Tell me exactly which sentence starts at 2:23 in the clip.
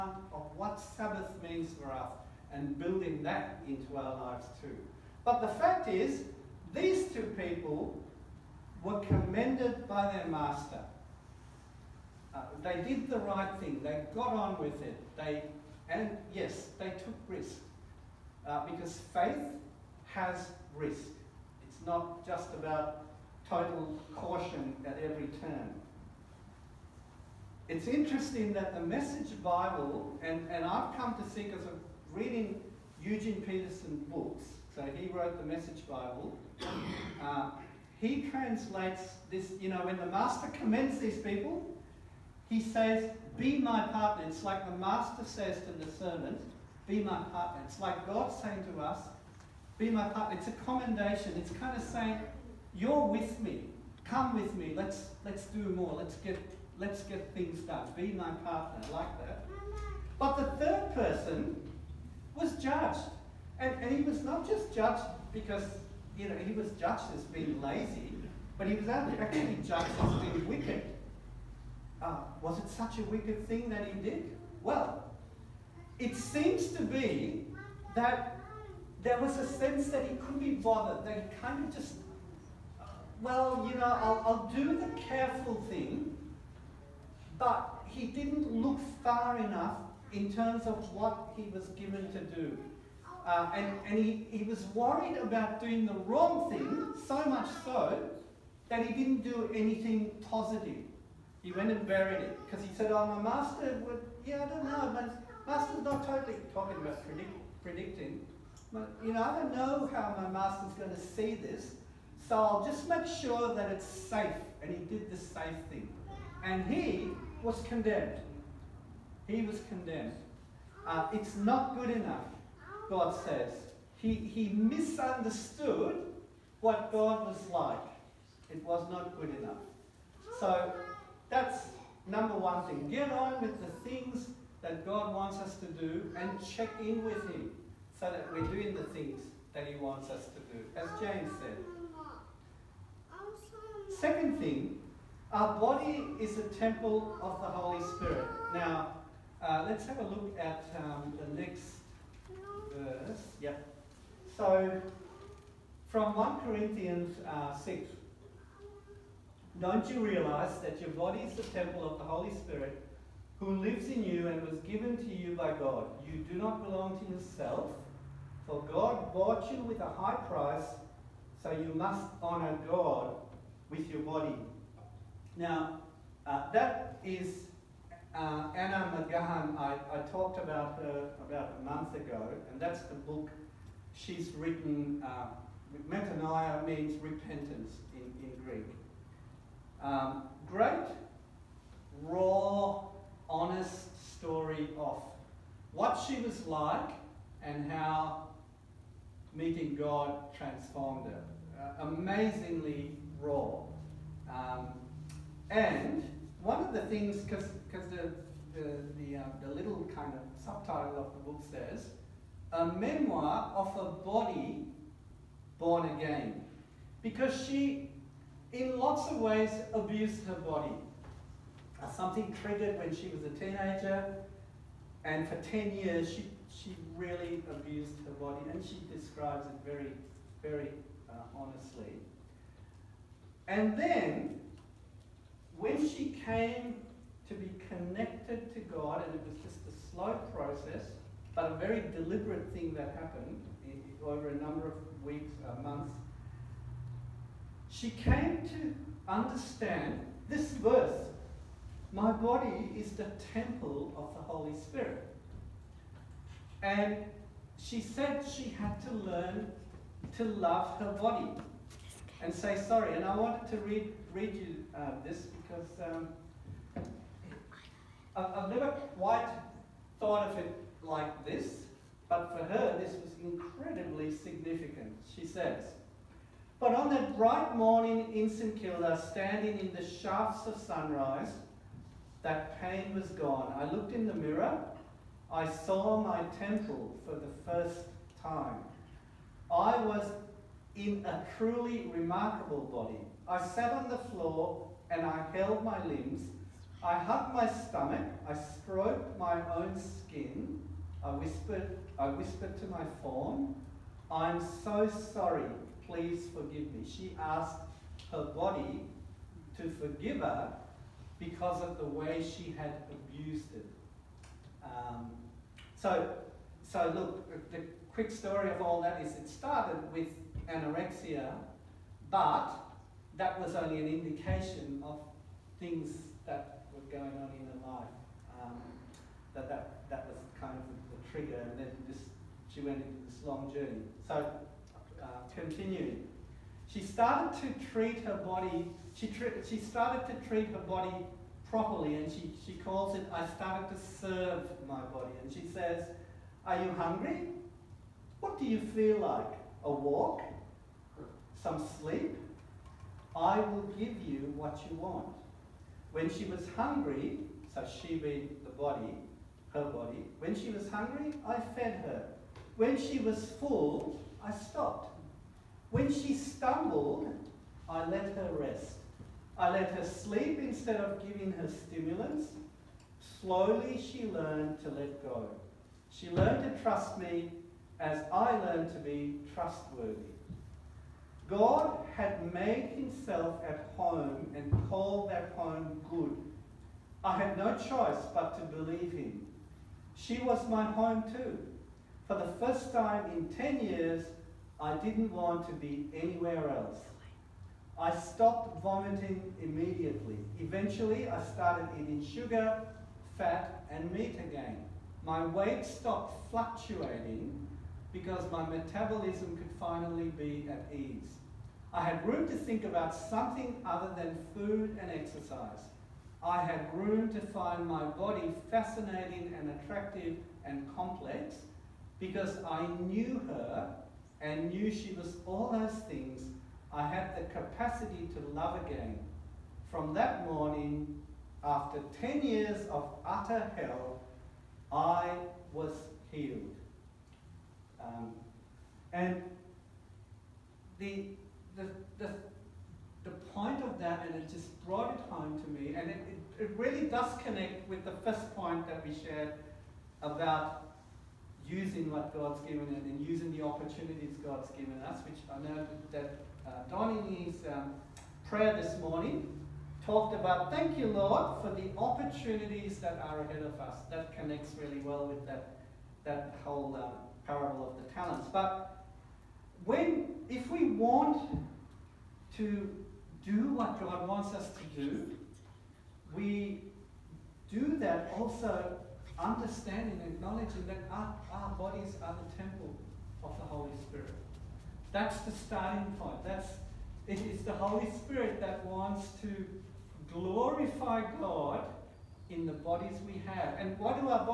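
Second thing, our body is a temple of the Holy Spirit.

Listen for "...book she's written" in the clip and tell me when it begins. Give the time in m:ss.
3:02.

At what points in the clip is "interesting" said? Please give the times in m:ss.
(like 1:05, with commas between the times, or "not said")
0:27.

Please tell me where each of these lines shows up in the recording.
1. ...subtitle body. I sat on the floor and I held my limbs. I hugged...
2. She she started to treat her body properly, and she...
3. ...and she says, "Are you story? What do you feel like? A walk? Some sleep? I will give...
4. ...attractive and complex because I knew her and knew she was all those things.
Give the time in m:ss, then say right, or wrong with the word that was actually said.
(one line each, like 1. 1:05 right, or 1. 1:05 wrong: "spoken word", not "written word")
1. 4:51 wrong: "remarkable", not "subtitle"
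2. 5:38 right
3. 5:45 wrong: "hungry", not "story"
4. 6:59 right.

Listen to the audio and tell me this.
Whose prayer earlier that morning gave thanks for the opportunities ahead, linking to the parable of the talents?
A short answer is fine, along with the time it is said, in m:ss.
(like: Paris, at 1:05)
Donnie, at 7:36.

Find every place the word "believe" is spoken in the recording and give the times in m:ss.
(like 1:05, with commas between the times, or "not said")
6:28.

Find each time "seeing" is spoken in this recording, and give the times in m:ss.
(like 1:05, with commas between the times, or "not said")
not said.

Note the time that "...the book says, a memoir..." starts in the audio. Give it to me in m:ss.
3:31.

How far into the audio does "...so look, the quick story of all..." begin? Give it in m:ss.
5:16.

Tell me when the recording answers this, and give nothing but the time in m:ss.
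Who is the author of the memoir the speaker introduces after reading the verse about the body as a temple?
2:58.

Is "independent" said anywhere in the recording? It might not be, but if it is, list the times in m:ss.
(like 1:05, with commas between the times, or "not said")
not said.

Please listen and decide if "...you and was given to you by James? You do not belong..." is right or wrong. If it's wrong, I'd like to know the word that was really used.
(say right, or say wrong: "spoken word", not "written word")
wrong: "God", not "James".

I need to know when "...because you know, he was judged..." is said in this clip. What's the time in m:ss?
1:05.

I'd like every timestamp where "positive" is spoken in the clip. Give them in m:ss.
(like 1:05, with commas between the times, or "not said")
1:40.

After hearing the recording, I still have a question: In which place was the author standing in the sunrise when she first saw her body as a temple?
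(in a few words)
St Kilda.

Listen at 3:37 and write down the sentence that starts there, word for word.
Because she, in lots of ways, abused her body.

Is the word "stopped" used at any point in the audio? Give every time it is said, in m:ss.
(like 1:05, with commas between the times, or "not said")
6:04, 6:37, 6:45.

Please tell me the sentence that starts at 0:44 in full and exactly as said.
It's like the master says to the servant, Be my partner.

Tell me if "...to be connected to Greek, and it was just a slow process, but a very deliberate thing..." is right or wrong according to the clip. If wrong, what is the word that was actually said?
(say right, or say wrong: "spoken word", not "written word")
wrong: "God", not "Greek".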